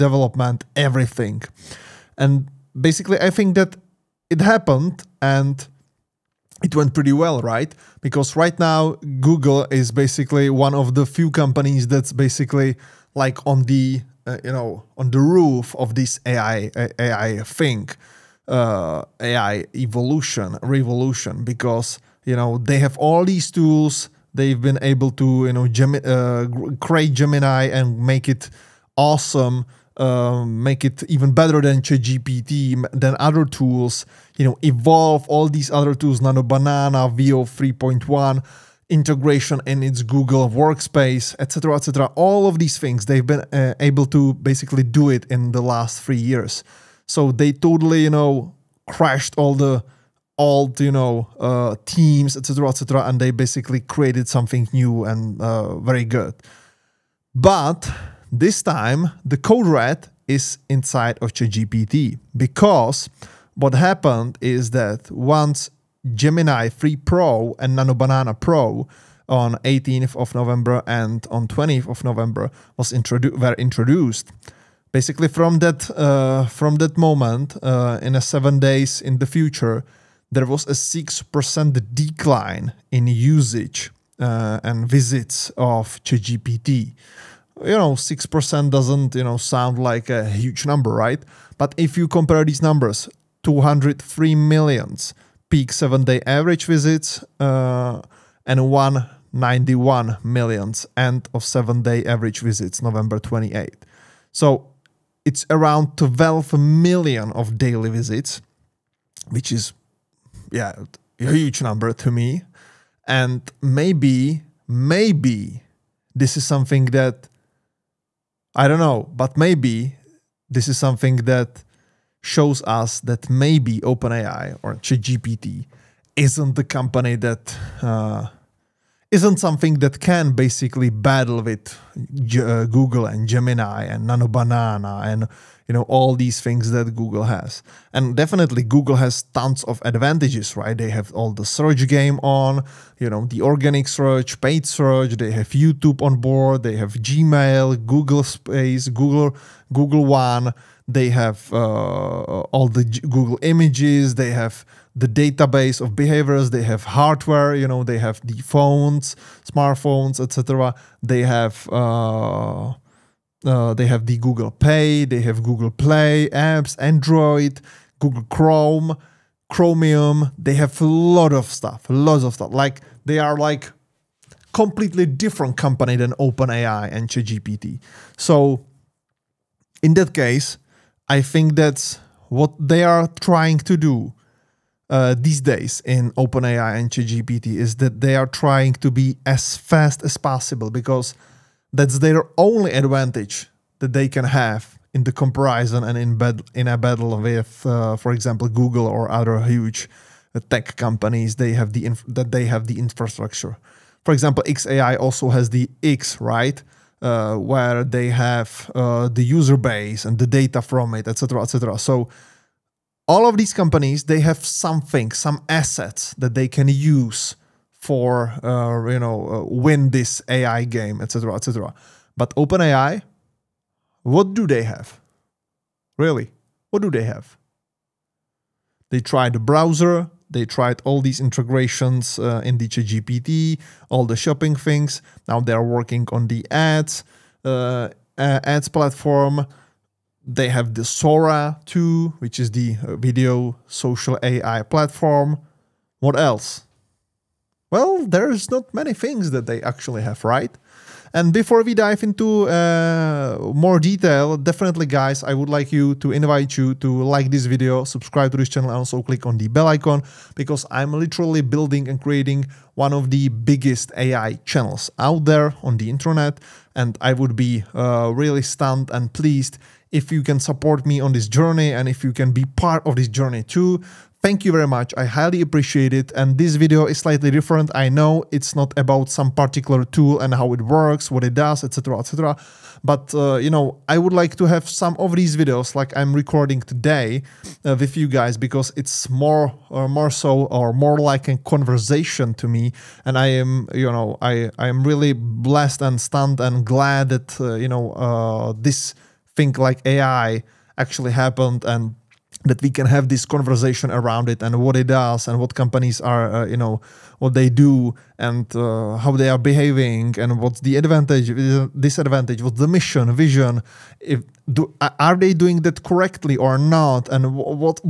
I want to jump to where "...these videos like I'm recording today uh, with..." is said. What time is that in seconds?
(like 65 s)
285 s.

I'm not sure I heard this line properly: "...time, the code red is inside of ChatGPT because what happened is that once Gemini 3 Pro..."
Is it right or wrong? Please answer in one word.
right.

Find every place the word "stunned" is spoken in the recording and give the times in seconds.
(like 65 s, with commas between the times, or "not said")
268 s, 295 s.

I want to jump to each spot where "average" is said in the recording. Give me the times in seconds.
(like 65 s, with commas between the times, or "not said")
96 s, 102 s.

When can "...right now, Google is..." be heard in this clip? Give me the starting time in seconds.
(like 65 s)
8 s.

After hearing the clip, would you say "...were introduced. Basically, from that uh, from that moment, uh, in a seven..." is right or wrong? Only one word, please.
right.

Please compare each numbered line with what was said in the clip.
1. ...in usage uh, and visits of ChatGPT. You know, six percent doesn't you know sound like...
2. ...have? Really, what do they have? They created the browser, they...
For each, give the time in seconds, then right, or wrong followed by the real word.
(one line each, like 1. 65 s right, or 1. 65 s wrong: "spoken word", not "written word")
1. 82 s right
2. 224 s wrong: "tried", not "created".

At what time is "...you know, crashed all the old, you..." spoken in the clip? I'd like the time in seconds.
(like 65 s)
48 s.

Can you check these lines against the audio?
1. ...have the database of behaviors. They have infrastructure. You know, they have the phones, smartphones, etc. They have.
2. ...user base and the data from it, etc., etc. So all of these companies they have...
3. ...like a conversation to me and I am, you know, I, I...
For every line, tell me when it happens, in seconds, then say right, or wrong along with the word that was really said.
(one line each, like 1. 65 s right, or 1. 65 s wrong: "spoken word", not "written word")
1. 154 s wrong: "hardware", not "infrastructure"
2. 209 s right
3. 290 s right.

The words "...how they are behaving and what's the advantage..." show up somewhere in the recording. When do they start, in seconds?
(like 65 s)
308 s.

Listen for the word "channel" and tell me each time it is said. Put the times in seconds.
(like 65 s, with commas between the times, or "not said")
258 s, 264 s.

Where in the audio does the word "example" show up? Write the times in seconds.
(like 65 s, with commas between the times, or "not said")
198 s, 204 s.